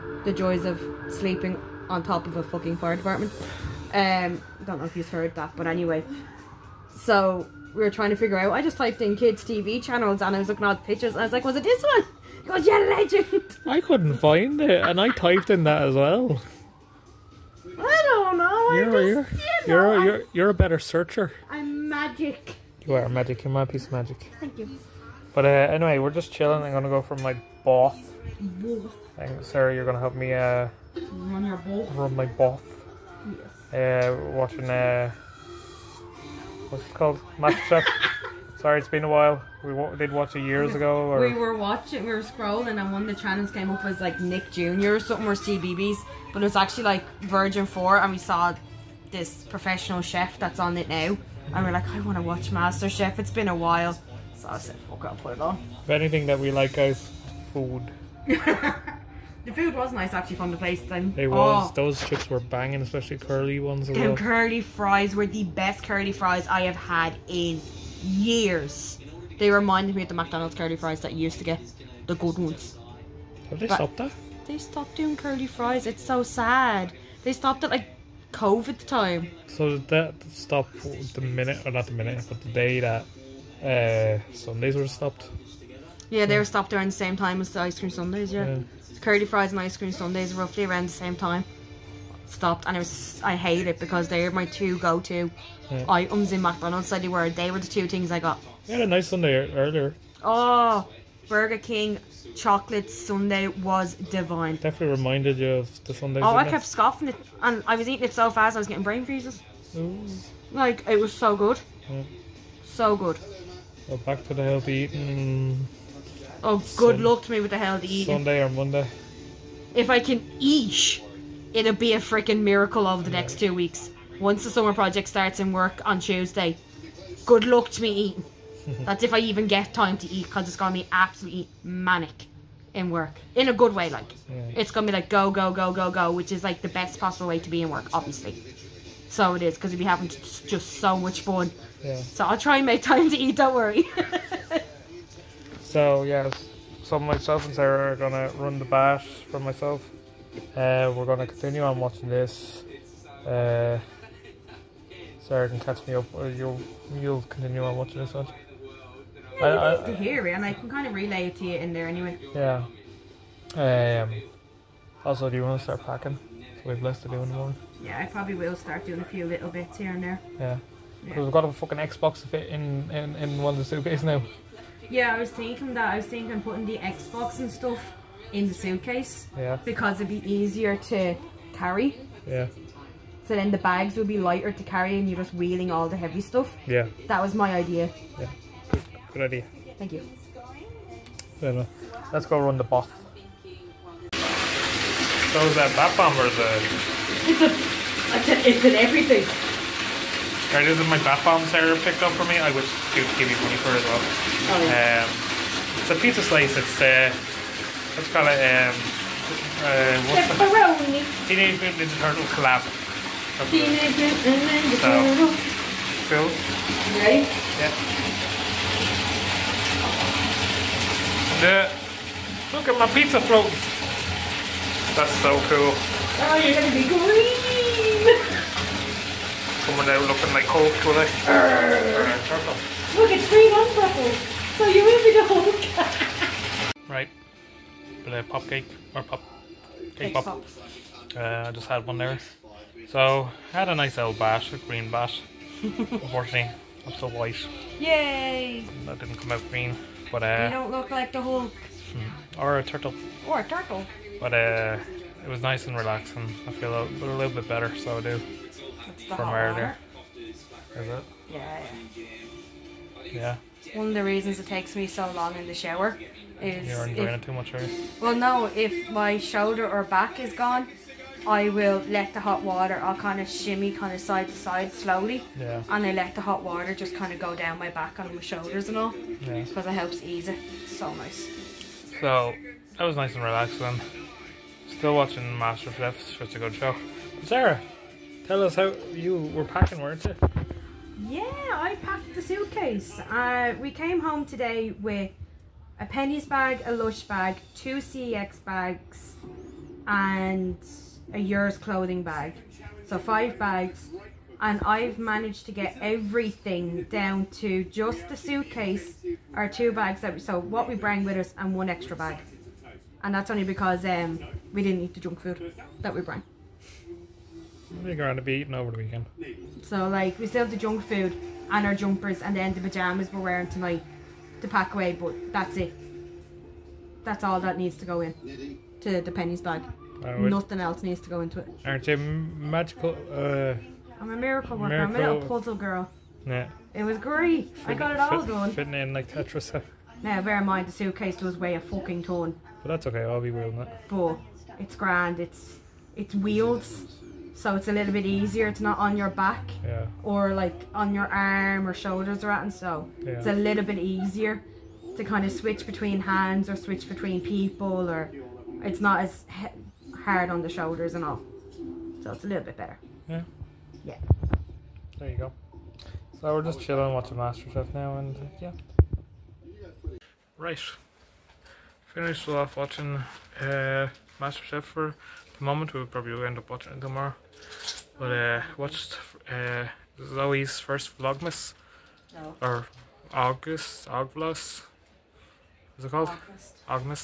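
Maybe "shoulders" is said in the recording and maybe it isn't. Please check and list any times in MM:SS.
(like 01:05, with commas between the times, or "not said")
04:29, 04:38, 05:51, 06:00.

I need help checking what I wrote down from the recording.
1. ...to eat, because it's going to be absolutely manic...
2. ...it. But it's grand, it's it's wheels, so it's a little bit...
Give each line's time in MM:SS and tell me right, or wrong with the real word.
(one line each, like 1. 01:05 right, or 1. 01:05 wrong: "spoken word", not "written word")
1. 02:09 right
2. 05:43 right.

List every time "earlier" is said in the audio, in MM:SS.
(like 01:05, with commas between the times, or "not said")
01:39, 04:19.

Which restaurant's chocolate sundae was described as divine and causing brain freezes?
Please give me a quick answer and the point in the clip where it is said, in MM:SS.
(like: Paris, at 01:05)
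Burger King, at 01:41.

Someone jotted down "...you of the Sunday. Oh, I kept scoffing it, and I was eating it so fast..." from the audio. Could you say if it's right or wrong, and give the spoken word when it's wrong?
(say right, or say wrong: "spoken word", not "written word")
right.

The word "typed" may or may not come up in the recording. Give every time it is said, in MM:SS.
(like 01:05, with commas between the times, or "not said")
00:08, 00:15.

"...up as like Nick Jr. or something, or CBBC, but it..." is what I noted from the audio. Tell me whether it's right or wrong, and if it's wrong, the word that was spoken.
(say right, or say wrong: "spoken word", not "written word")
right.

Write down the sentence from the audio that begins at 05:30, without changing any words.
Nothing else needs to go into it.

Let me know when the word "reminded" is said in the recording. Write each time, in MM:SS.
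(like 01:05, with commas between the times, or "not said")
01:09, 01:44.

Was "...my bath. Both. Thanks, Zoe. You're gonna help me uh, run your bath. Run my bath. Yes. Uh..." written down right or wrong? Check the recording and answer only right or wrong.
wrong.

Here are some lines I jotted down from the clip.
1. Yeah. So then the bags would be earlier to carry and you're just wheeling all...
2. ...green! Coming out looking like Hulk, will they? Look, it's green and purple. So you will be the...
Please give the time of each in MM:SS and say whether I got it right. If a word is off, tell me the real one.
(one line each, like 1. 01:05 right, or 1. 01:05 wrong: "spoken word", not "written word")
1. 03:02 wrong: "lighter", not "earlier"
2. 03:46 right.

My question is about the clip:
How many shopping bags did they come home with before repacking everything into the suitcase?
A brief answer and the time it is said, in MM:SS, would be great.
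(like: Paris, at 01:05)
5, at 05:02.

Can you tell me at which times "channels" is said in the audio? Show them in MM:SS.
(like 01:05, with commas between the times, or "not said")
00:09, 00:43.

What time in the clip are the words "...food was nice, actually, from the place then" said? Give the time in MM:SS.
00:59.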